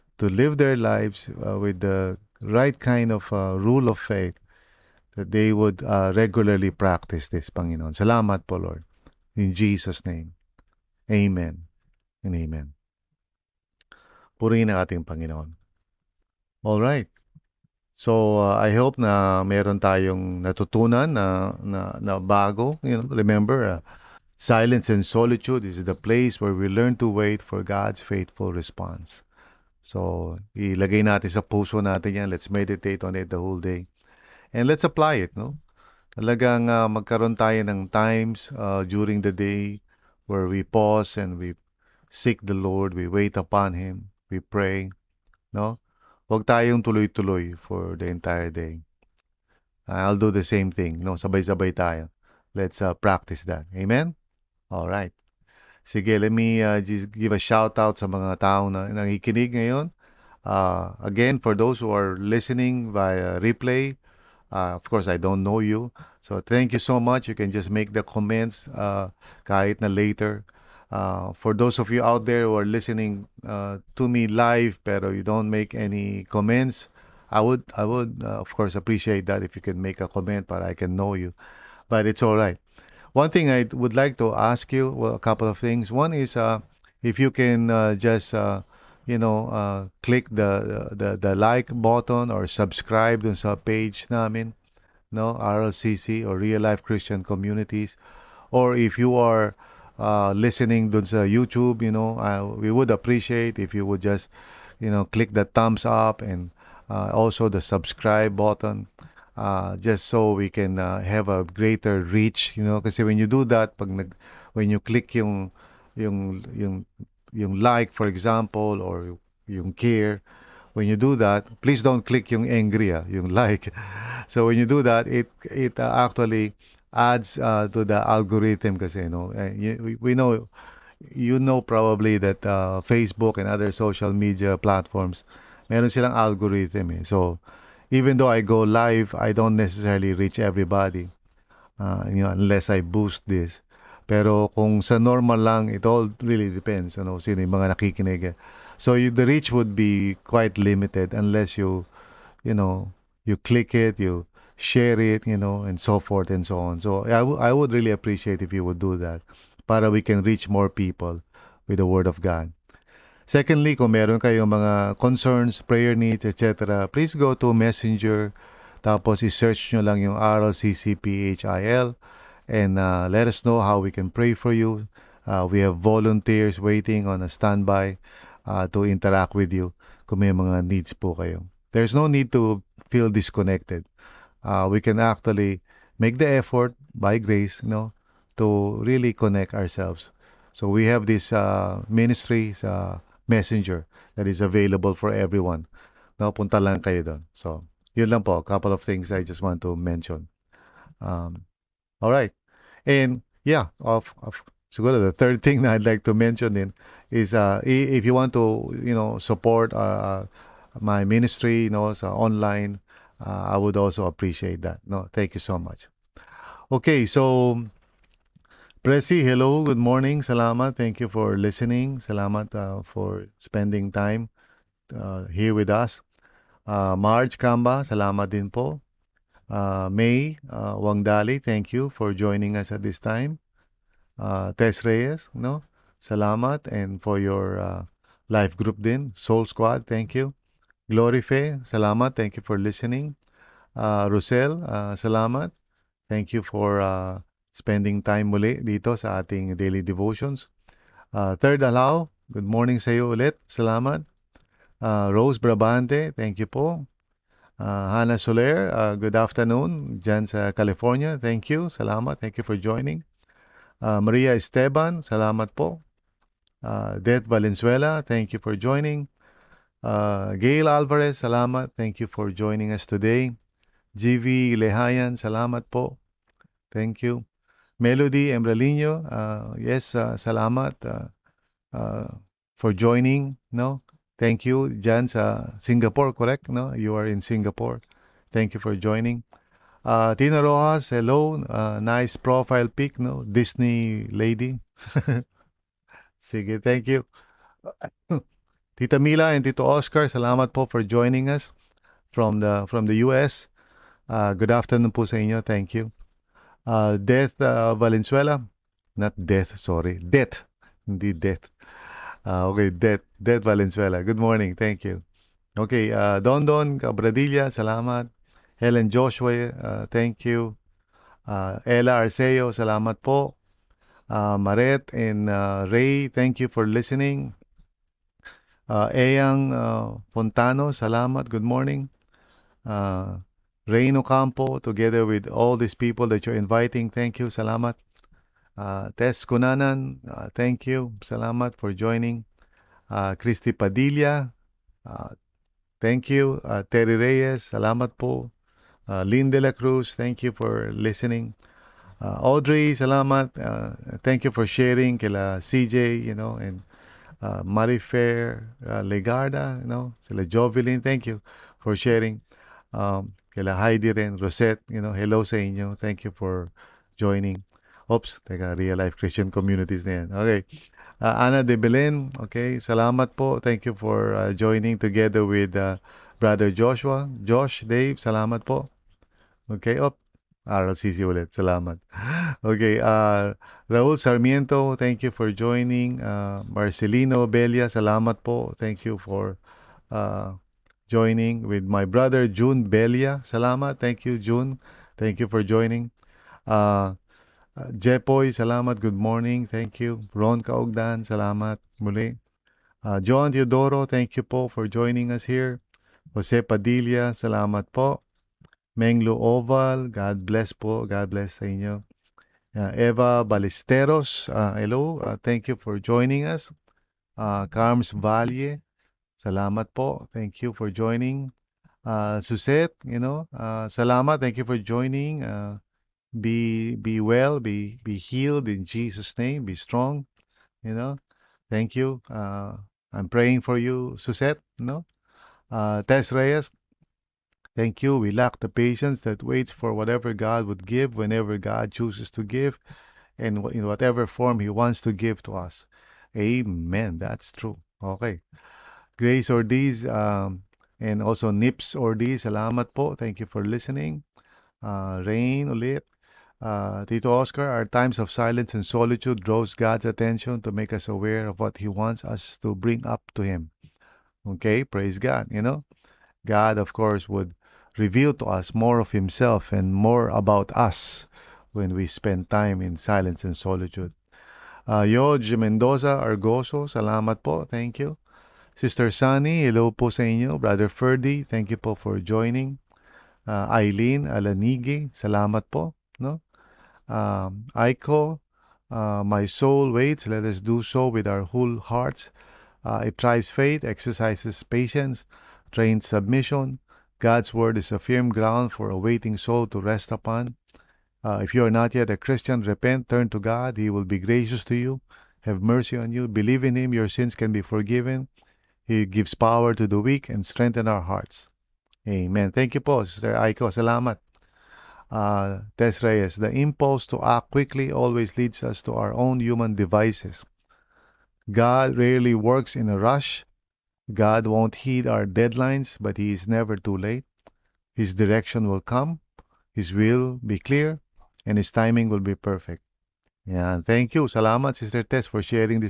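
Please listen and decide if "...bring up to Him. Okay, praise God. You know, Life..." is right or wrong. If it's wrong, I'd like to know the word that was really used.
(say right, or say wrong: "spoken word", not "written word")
wrong: "God", not "Life".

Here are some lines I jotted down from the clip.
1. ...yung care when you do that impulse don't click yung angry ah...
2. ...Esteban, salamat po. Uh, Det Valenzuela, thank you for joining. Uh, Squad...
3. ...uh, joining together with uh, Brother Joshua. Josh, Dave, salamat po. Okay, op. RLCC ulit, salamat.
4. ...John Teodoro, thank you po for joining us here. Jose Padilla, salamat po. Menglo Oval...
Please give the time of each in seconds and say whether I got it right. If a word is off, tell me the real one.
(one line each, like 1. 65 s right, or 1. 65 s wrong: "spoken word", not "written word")
1. 119 s wrong: "please", not "impulse"
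2. 264 s wrong: "Gail", not "Squad"
3. 374 s right
4. 403 s right.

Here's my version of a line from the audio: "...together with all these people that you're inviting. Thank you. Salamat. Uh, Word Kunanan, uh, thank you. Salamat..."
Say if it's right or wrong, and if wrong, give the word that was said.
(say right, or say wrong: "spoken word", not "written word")
wrong: "Tess", not "Word".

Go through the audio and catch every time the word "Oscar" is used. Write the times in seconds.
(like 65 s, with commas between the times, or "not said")
299 s, 457 s.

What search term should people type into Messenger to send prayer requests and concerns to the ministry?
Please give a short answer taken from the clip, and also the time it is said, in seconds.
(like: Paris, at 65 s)
RLCCPHIL, at 170 s.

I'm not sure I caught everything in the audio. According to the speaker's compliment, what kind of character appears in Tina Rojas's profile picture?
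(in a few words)
Disney lady.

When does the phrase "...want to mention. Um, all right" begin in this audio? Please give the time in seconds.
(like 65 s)
199 s.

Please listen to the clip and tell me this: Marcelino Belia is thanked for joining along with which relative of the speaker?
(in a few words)
June Belia.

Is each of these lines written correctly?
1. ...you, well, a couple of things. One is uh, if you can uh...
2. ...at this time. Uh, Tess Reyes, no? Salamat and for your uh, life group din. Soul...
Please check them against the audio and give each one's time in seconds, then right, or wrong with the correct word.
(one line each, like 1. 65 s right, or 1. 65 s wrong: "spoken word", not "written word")
1. 84 s right
2. 232 s right.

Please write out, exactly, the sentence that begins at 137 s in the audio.
so even though I go live, I don't necessarily reach everybody.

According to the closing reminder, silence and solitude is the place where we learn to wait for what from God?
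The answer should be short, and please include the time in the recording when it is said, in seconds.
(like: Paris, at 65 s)
faithful response, at 28 s.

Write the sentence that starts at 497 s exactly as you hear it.
God's word is a firm ground for a waiting soul to rest upon.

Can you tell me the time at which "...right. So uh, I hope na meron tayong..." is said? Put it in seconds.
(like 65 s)
16 s.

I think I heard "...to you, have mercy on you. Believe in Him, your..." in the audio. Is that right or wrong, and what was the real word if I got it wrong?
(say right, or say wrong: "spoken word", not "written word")
right.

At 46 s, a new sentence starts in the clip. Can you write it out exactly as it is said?
Huwag tayong tuloy-tuloy for the entire day.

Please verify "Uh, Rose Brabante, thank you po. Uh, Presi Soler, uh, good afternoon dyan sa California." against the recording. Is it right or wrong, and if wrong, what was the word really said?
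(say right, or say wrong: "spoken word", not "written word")
wrong: "Hannah", not "Presi".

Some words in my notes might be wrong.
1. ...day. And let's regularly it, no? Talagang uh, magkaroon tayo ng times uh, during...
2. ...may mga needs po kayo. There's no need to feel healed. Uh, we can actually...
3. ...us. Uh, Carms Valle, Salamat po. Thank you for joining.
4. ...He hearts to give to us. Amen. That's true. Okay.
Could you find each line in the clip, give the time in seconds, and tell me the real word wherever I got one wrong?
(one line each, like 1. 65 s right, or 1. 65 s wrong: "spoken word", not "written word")
1. 33 s wrong: "apply", not "regularly"
2. 180 s wrong: "disconnected", not "healed"
3. 416 s right
4. 444 s wrong: "wants", not "hearts".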